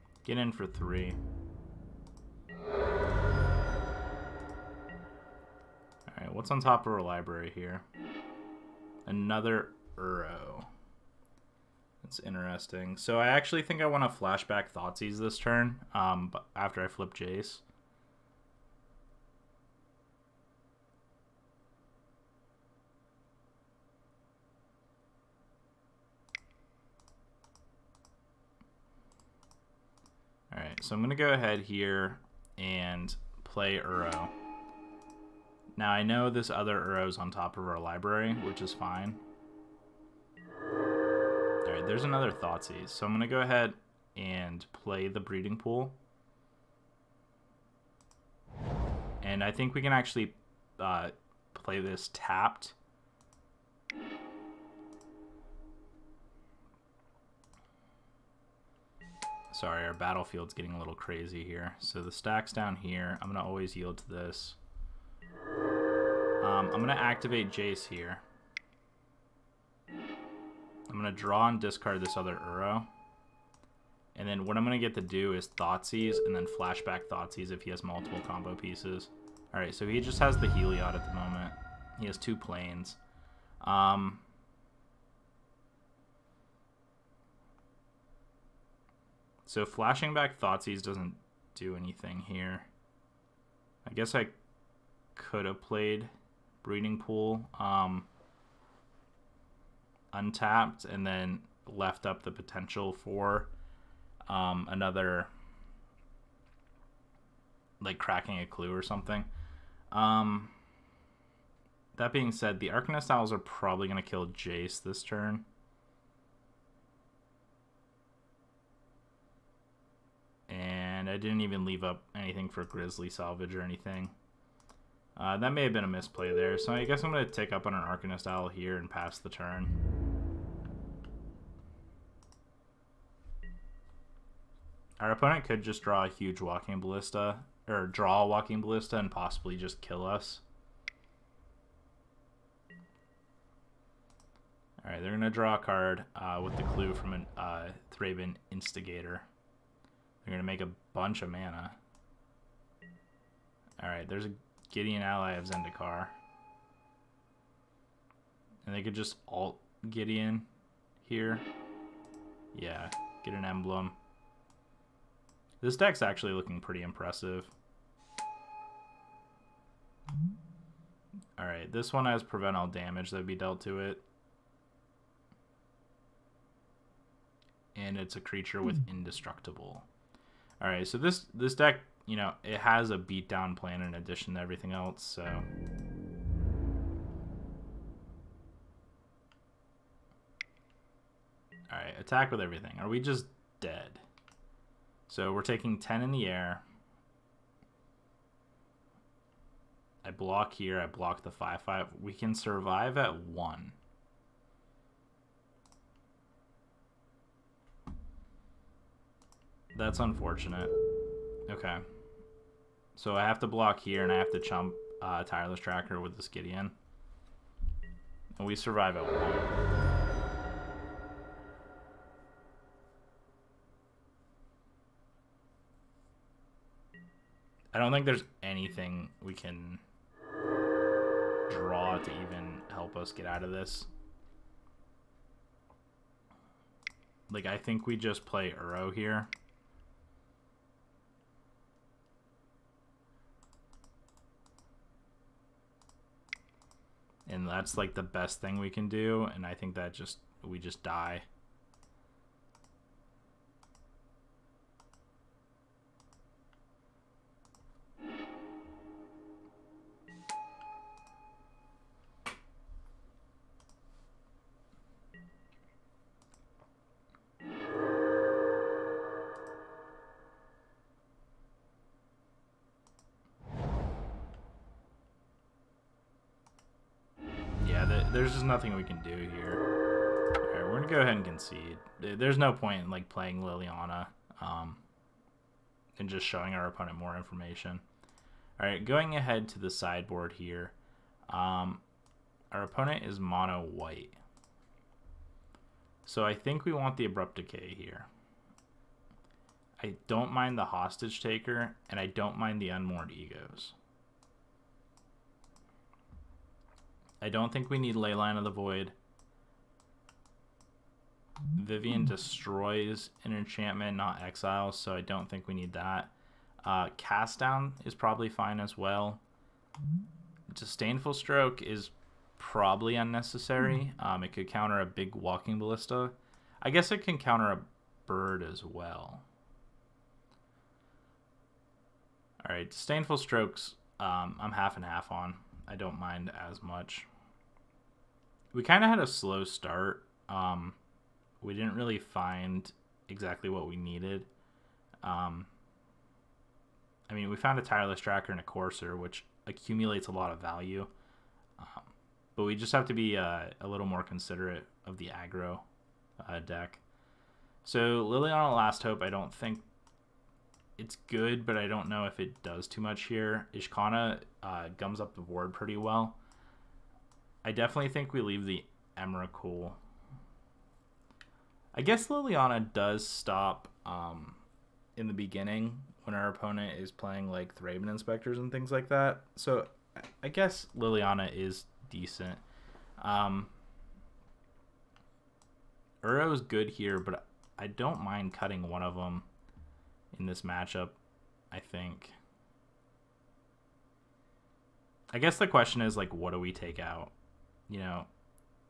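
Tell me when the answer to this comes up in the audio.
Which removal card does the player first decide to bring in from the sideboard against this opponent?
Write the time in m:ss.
4:57.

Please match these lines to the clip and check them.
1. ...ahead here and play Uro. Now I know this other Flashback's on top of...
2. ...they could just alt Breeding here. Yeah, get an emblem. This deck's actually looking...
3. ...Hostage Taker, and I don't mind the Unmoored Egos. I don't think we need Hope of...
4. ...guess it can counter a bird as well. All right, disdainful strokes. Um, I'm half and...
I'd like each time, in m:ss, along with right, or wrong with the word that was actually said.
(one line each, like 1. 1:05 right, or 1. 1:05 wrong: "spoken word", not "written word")
1. 0:31 wrong: "Uro", not "Flashback"
2. 2:38 wrong: "Gideon", not "Breeding"
3. 5:00 wrong: "Leyline", not "Hope"
4. 5:26 right.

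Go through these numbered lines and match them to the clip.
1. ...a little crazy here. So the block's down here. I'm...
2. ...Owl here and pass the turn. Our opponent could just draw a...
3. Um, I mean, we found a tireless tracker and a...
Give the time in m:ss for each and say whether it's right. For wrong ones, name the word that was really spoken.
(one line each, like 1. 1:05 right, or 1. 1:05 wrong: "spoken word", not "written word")
1. 1:00 wrong: "stack", not "block"
2. 2:08 right
3. 5:45 right.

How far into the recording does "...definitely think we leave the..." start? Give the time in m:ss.
6:07.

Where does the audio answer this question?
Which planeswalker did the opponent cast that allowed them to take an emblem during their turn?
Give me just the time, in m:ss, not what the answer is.
2:34.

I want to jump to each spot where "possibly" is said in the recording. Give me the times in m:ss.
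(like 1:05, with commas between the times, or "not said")
2:19.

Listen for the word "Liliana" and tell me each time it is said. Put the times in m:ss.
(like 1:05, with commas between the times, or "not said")
4:43, 5:58, 6:12, 6:20.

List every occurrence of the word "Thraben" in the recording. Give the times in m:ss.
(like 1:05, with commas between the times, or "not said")
6:17.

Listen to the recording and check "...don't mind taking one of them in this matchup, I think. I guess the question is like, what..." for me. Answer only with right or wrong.
wrong.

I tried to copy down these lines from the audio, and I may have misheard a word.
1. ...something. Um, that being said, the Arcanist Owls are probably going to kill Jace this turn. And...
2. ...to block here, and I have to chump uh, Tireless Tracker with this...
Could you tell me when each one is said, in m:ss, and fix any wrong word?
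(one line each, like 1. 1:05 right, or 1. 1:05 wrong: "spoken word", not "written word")
1. 1:48 right
2. 3:33 right.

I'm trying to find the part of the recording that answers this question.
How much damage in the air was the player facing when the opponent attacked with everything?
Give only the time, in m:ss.
3:15.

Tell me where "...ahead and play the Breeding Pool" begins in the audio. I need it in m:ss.
0:43.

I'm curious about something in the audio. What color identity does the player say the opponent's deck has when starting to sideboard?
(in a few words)
Mono white.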